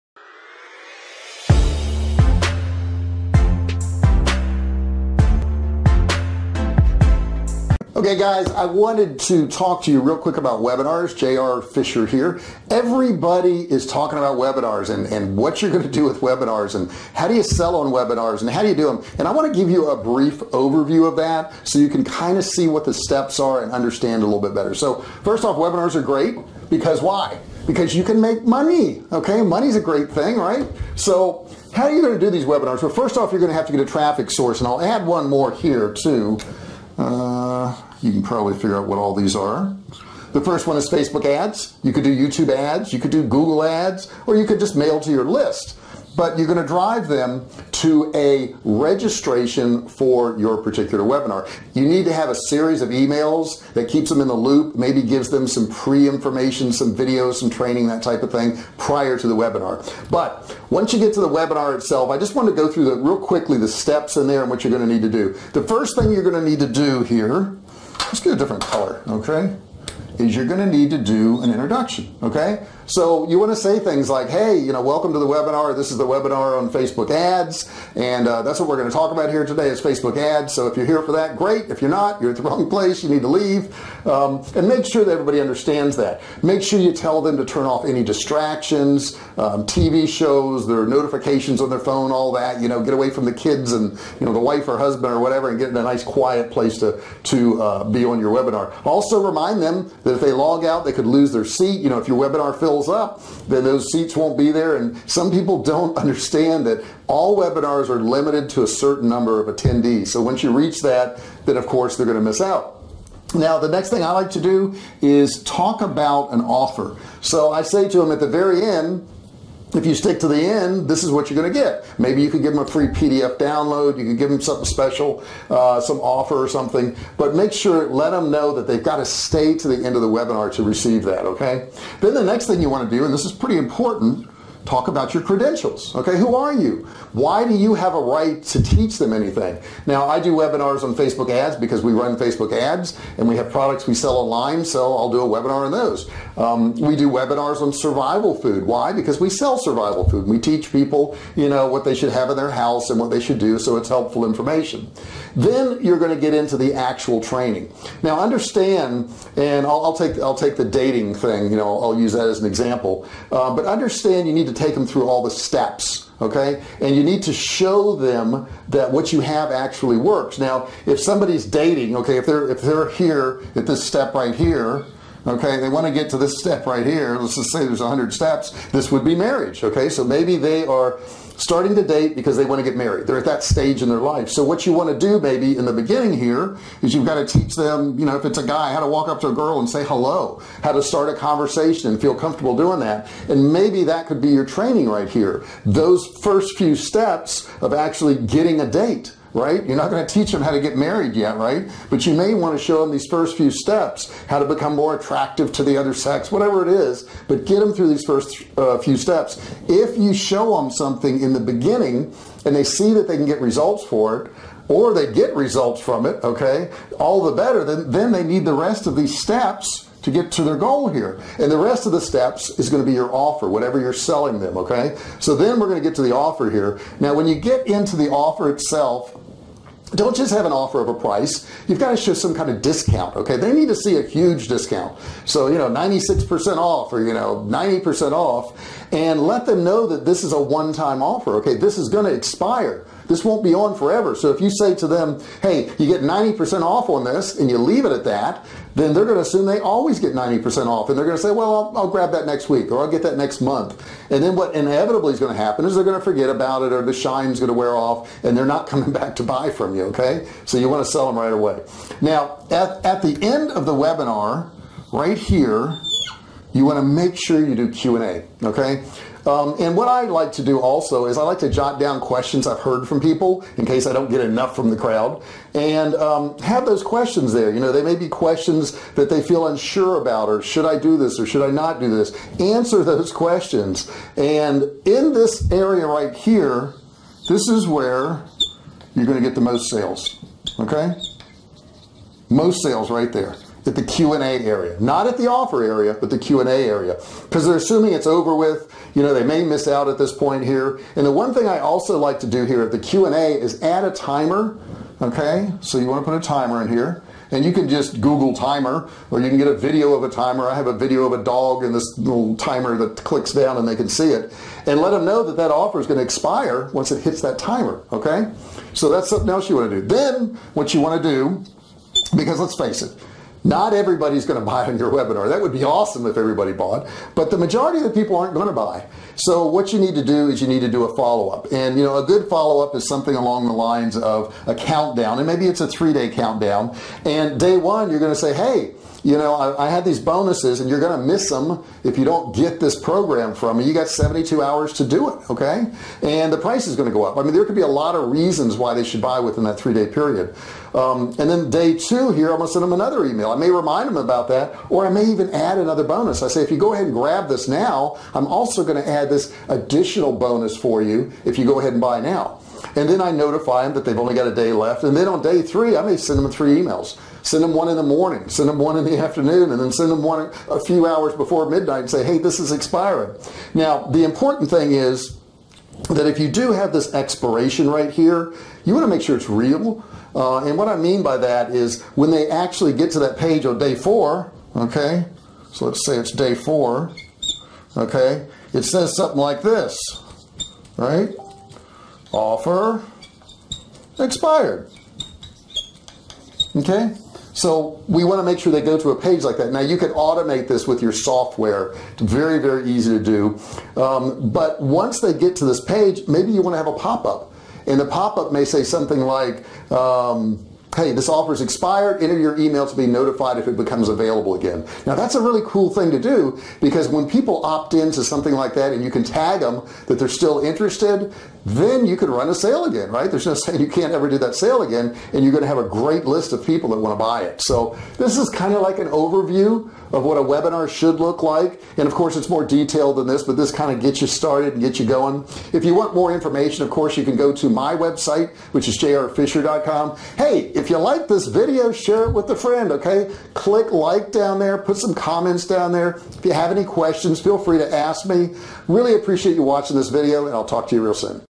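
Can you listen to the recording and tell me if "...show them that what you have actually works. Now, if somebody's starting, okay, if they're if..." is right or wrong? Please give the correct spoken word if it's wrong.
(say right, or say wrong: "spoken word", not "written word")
wrong: "dating", not "starting".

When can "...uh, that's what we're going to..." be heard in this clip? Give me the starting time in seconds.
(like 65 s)
78 s.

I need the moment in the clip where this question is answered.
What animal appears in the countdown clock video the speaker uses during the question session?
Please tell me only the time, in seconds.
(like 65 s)
311 s.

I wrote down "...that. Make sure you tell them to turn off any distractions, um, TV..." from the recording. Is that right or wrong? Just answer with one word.
right.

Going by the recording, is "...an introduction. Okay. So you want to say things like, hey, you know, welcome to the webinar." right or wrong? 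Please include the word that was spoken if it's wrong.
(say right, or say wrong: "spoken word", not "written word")
right.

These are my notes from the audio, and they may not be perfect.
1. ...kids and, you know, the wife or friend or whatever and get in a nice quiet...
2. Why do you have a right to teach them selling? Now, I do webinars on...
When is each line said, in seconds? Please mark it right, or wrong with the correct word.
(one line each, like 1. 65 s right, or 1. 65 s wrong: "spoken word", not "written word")
1. 93 s wrong: "husband", not "friend"
2. 137 s wrong: "anything", not "selling".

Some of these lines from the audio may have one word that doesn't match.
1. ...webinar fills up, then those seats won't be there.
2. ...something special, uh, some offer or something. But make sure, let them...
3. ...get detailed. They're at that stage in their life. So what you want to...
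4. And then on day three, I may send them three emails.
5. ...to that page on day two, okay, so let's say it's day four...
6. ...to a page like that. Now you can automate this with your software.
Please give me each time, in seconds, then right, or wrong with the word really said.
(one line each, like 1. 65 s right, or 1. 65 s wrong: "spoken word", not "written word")
1. 102 s right
2. 124 s right
3. 182 s wrong: "married", not "detailed"
4. 364 s right
5. 382 s wrong: "four", not "two"
6. 398 s right.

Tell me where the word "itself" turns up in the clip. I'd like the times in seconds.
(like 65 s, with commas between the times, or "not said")
61 s, 228 s.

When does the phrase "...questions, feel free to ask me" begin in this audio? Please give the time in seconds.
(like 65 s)
446 s.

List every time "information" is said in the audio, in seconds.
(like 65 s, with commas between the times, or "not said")
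55 s, 154 s, 436 s.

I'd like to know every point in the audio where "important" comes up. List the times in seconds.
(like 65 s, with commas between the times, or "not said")
133 s, 374 s.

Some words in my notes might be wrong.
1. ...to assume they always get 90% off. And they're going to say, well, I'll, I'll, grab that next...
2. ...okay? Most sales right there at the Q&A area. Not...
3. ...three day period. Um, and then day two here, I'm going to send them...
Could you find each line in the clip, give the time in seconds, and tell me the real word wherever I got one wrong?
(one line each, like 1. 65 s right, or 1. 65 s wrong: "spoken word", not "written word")
1. 249 s right
2. 290 s right
3. 349 s right.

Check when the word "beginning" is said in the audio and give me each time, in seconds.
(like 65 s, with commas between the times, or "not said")
185 s, 211 s.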